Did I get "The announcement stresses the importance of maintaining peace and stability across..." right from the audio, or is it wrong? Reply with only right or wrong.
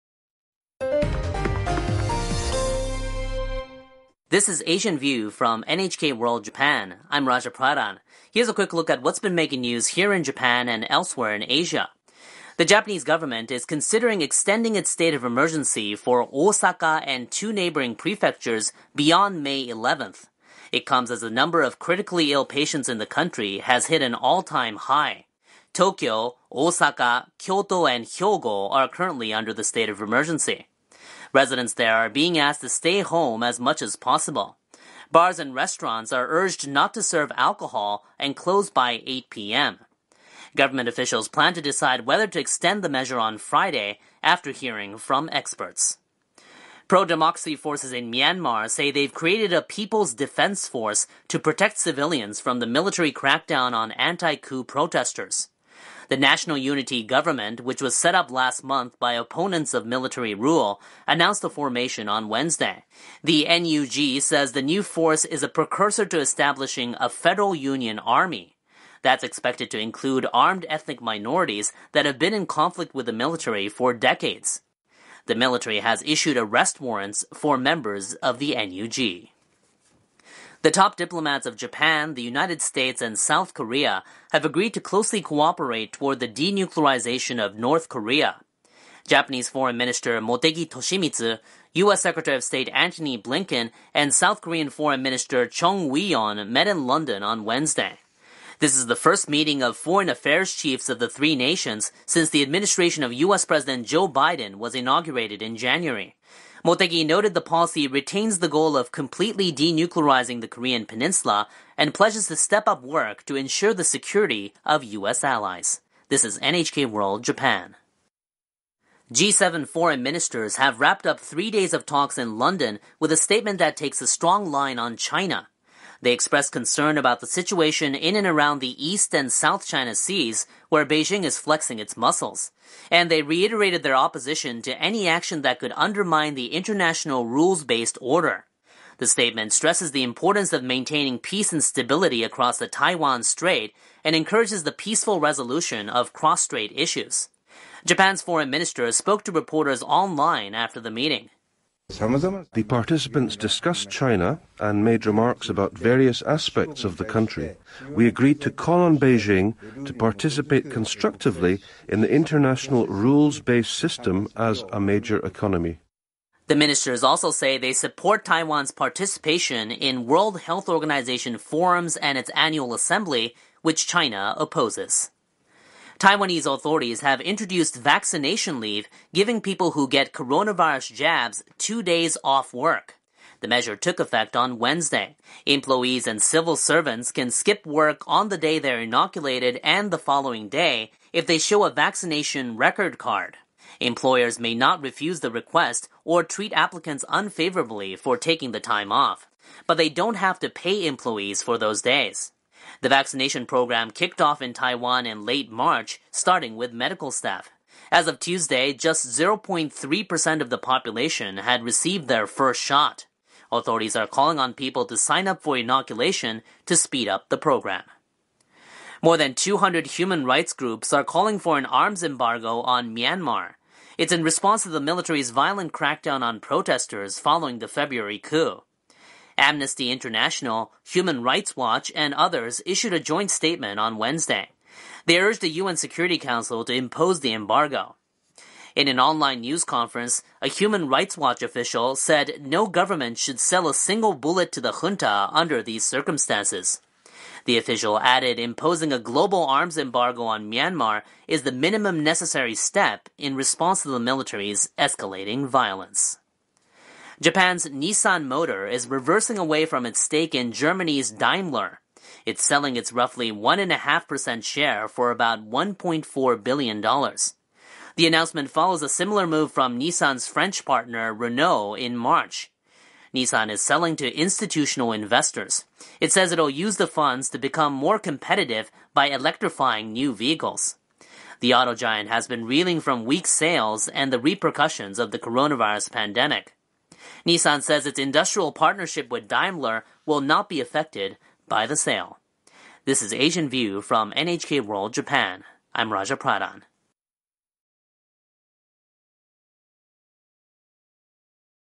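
wrong.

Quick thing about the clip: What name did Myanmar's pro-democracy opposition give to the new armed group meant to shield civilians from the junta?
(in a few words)
People's Defense Force.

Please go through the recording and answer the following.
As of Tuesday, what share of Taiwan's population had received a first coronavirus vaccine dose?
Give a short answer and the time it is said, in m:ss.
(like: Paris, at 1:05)
0.3%, at 3:29.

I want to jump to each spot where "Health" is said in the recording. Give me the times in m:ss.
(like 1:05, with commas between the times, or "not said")
2:50.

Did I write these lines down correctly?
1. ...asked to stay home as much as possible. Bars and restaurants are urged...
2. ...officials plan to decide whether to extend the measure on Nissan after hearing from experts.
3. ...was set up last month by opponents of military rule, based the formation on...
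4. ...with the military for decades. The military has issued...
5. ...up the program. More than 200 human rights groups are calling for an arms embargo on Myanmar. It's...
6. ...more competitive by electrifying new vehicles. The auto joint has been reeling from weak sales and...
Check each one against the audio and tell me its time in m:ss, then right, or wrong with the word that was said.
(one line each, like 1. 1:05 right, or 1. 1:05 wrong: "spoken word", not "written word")
1. 0:32 right
2. 0:40 wrong: "Friday", not "Nissan"
3. 0:57 wrong: "announced", not "based"
4. 1:12 right
5. 3:37 right
6. 4:37 wrong: "giant", not "joint".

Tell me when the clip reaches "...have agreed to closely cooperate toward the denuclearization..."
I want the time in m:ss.
1:24.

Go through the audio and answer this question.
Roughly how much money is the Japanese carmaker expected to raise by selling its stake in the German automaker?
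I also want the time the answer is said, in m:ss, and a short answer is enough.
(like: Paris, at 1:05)
$1.4 billion, at 4:25.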